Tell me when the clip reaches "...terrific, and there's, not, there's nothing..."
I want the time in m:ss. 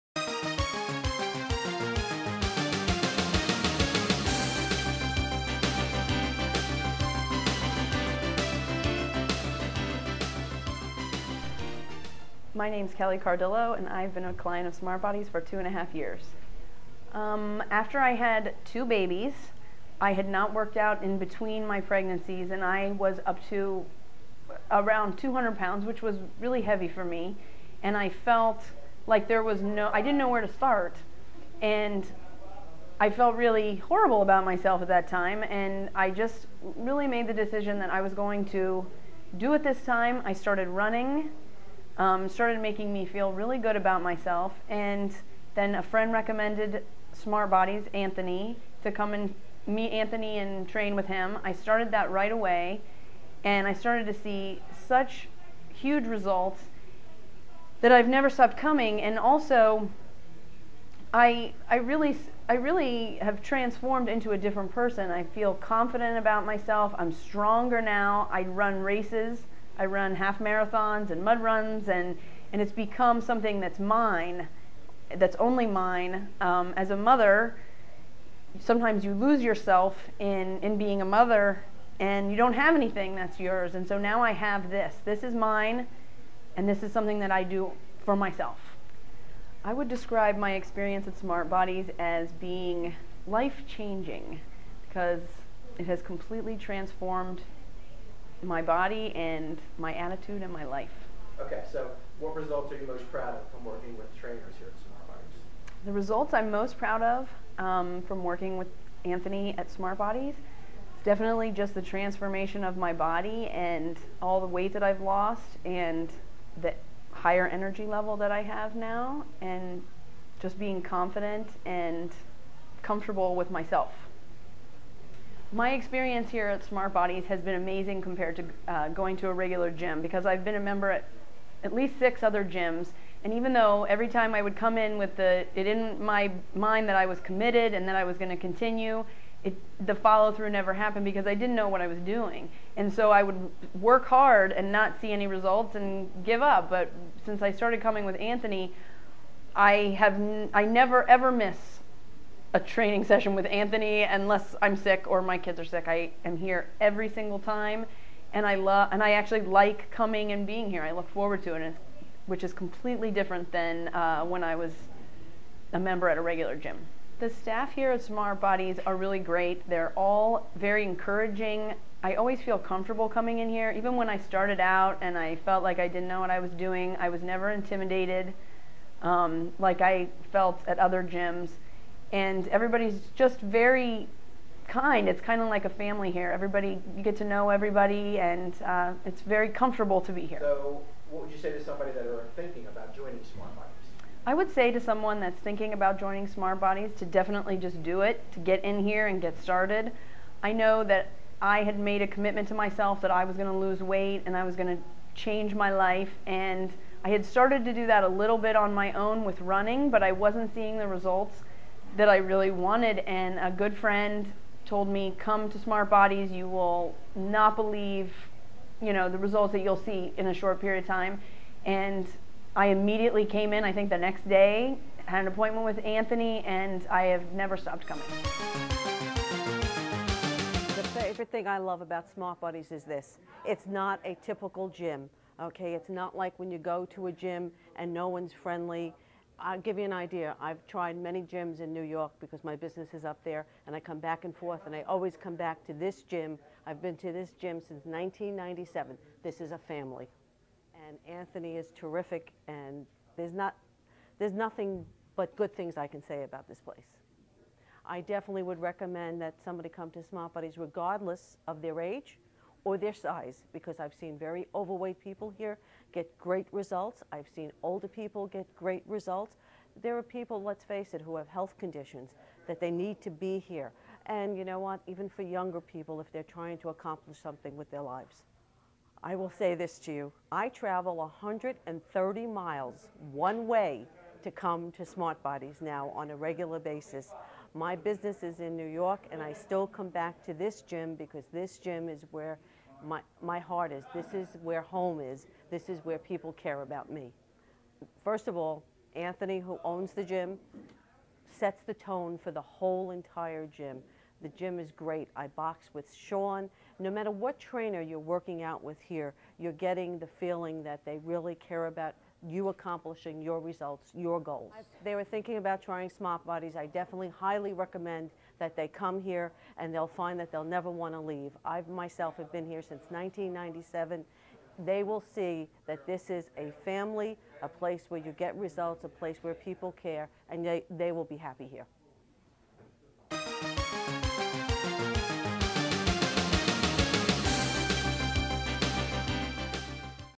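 4:11.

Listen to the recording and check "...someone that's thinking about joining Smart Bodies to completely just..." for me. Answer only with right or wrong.
wrong.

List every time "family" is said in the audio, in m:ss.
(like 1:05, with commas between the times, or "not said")
3:05, 4:09, 5:26.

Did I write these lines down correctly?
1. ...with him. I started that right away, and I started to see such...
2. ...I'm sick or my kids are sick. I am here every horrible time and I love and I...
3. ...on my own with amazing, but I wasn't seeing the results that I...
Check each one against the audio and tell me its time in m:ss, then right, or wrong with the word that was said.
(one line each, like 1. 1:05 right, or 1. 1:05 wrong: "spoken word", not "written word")
1. 0:50 right
2. 2:34 wrong: "single", not "horrible"
3. 3:28 wrong: "running", not "amazing".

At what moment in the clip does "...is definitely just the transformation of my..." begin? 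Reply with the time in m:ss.
1:50.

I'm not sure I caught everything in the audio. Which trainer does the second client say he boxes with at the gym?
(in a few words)
Sean.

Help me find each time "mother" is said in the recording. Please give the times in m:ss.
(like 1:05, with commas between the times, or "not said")
1:16, 1:21.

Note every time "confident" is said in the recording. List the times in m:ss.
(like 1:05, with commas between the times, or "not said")
1:05, 2:00.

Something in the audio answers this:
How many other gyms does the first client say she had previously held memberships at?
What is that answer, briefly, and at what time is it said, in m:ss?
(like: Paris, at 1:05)
6, at 2:11.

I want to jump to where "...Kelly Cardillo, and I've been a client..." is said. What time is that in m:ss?
0:12.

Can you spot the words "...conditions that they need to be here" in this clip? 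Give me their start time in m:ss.
4:31.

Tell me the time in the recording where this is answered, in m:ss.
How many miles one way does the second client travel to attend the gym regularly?
4:40.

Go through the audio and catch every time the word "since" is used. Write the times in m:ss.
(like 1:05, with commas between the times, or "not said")
2:27, 4:07, 5:22.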